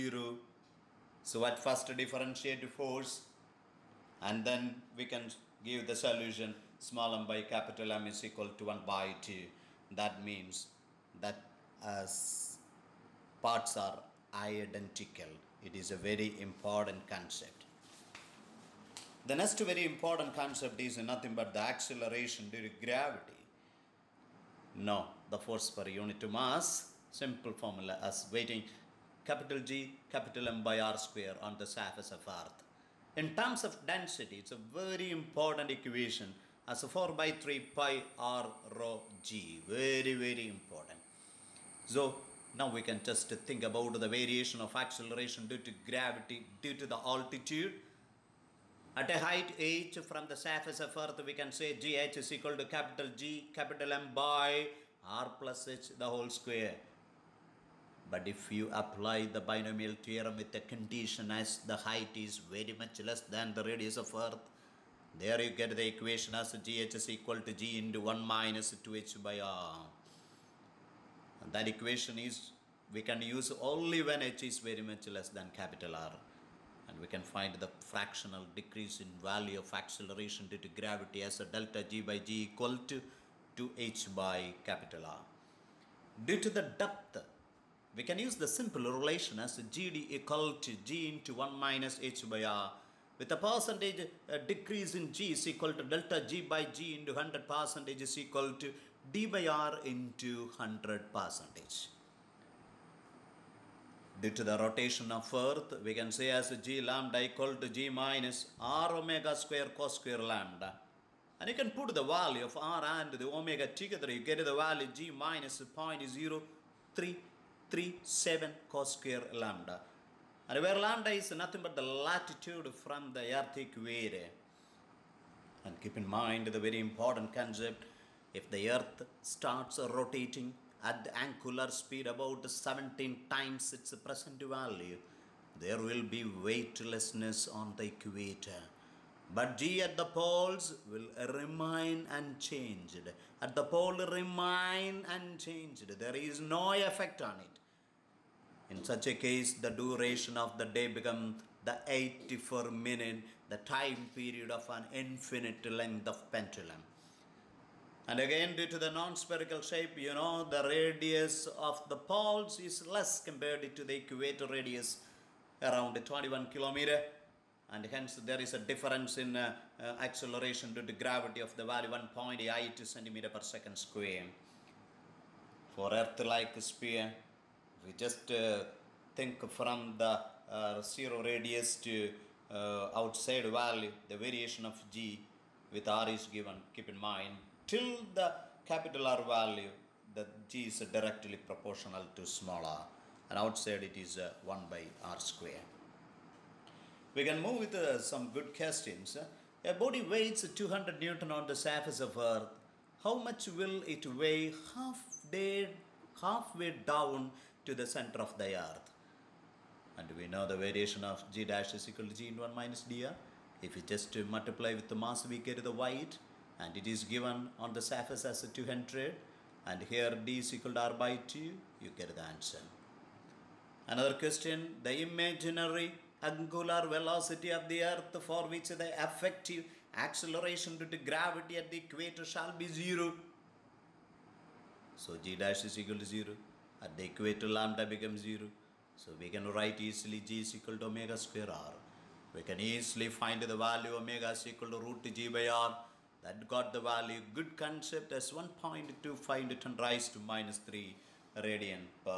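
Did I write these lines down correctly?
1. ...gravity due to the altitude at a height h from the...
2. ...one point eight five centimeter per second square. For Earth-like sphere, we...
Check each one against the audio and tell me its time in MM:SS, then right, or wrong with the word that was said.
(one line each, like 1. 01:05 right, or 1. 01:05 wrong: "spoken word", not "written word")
1. 00:45 right
2. 02:51 wrong: "two", not "five".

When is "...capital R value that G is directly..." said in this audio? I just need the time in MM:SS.
03:08.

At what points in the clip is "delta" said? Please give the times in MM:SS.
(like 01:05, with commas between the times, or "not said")
01:21, 01:35.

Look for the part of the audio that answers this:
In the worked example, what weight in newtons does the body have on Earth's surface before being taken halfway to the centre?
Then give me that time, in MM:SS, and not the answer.
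03:20.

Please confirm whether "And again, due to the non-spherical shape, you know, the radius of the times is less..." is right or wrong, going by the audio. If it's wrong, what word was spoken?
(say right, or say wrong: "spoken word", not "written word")
wrong: "poles", not "times".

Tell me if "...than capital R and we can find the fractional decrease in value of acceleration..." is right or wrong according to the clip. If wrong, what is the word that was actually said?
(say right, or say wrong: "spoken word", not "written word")
right.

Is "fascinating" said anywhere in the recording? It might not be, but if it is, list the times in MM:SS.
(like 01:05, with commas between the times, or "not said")
not said.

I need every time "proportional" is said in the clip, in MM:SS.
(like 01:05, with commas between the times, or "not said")
03:11.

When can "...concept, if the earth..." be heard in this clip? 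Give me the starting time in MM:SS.
02:07.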